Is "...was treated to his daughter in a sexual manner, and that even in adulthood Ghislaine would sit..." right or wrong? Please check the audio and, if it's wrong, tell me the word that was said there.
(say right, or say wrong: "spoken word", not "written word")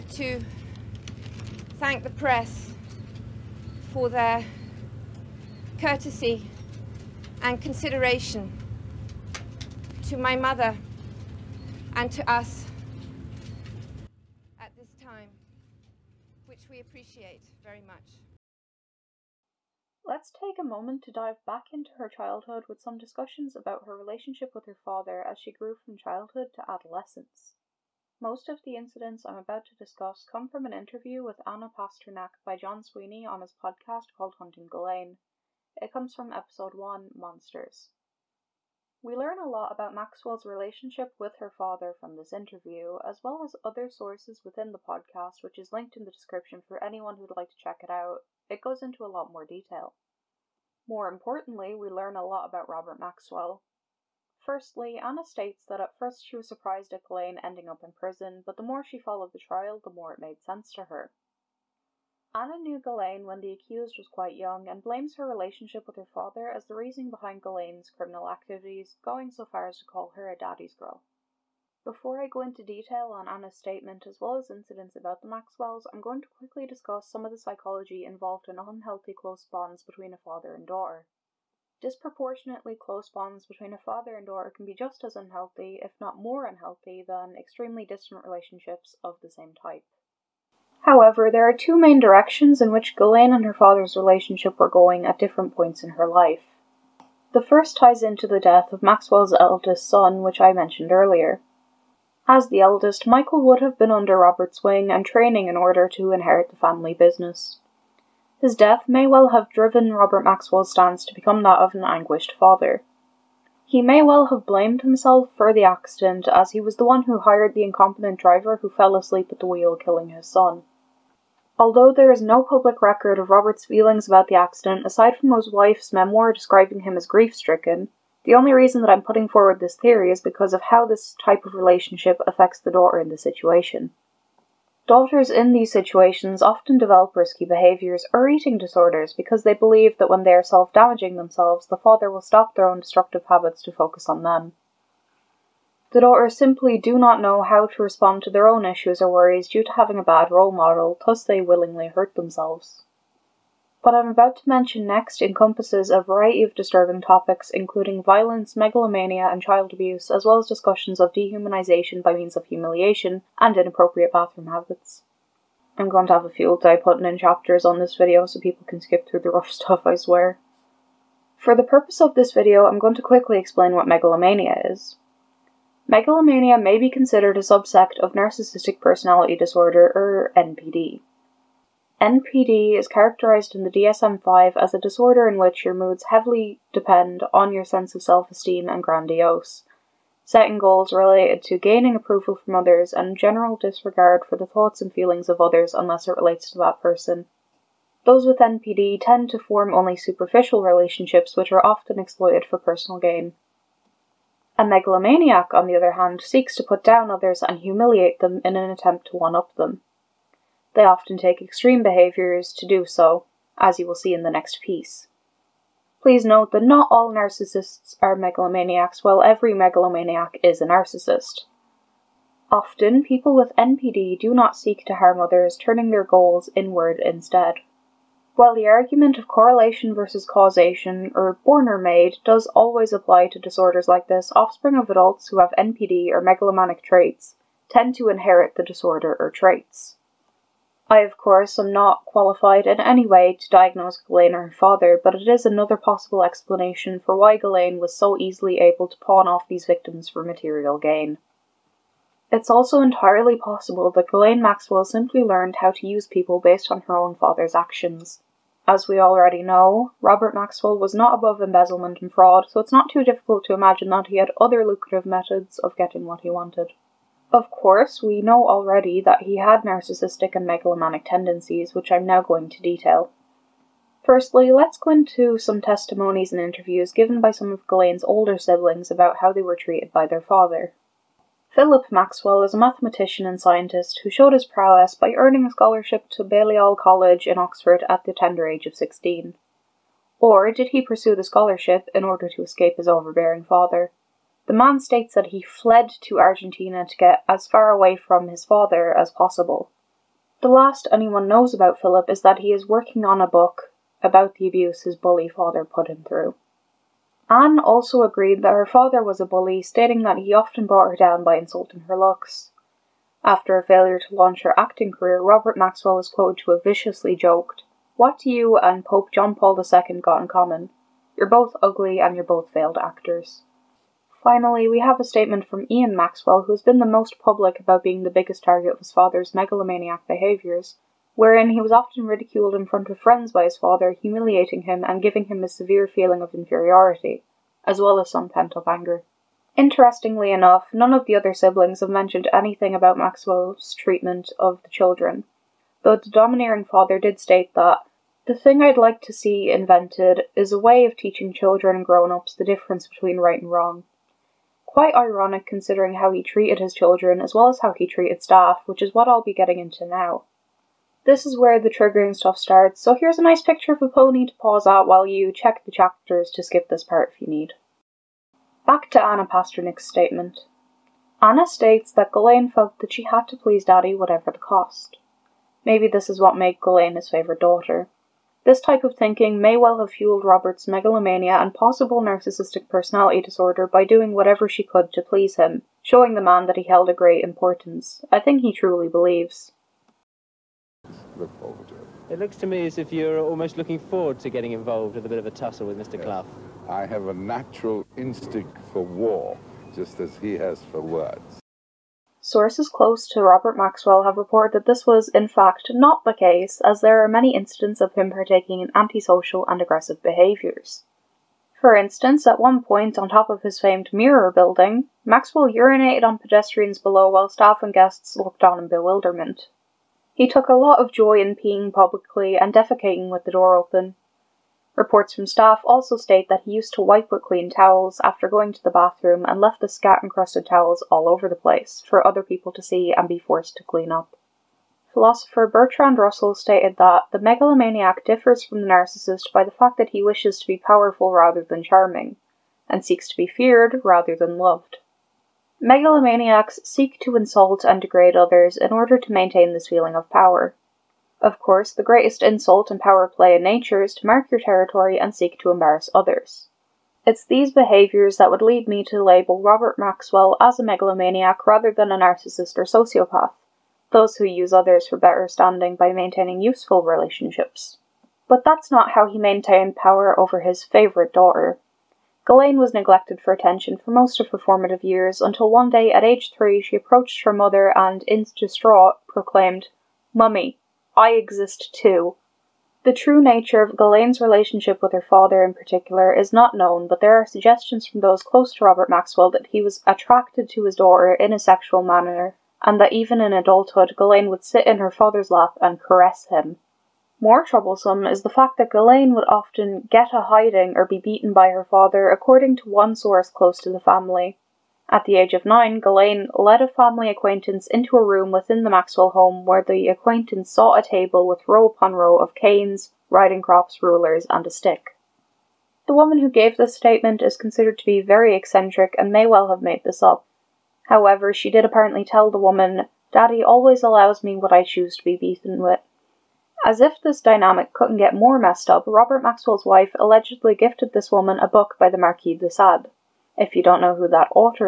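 wrong: "attracted", not "treated".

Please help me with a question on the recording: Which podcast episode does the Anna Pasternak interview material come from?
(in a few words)
Monsters.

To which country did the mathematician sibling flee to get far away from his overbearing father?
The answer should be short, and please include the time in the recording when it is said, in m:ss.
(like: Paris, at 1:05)
Argentina, at 4:56.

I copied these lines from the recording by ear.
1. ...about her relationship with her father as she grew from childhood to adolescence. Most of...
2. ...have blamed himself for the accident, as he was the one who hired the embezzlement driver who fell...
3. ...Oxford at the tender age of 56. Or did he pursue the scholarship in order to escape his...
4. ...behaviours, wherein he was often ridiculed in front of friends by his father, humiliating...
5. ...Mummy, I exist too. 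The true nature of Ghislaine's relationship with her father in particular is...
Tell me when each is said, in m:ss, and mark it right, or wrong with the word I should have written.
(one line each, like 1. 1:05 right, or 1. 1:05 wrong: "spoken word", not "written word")
1. 0:23 right
2. 1:54 wrong: "incompetent", not "embezzlement"
3. 4:47 wrong: "16", not "56"
4. 5:30 right
5. 8:00 right.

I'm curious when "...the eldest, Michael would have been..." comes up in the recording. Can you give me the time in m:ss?
1:42.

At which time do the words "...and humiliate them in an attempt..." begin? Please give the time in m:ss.
3:27.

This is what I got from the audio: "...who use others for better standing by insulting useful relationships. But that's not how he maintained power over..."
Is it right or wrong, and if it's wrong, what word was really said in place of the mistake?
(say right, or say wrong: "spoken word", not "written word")
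wrong: "maintaining", not "insulting".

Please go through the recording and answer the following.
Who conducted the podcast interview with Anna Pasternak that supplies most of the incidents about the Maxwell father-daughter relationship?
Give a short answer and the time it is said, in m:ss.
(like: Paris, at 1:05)
John Sweeney, at 0:32.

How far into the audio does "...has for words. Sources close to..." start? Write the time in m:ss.
6:40.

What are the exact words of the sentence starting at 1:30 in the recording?
However, there are two main directions in which Ghislaine and her father's relationship were going at different points in her life.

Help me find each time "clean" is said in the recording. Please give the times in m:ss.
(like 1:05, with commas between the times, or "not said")
7:07, 7:13.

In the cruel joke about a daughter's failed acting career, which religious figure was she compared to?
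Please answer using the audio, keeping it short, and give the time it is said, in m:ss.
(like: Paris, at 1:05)
Pope John Paul II, at 5:18.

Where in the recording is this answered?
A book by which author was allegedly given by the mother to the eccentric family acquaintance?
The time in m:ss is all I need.
8:51.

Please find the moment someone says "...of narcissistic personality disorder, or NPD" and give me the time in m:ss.
2:57.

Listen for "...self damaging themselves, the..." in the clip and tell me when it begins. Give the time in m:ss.
2:20.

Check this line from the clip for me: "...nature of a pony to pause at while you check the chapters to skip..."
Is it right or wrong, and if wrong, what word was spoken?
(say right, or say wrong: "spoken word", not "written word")
wrong: "picture", not "nature".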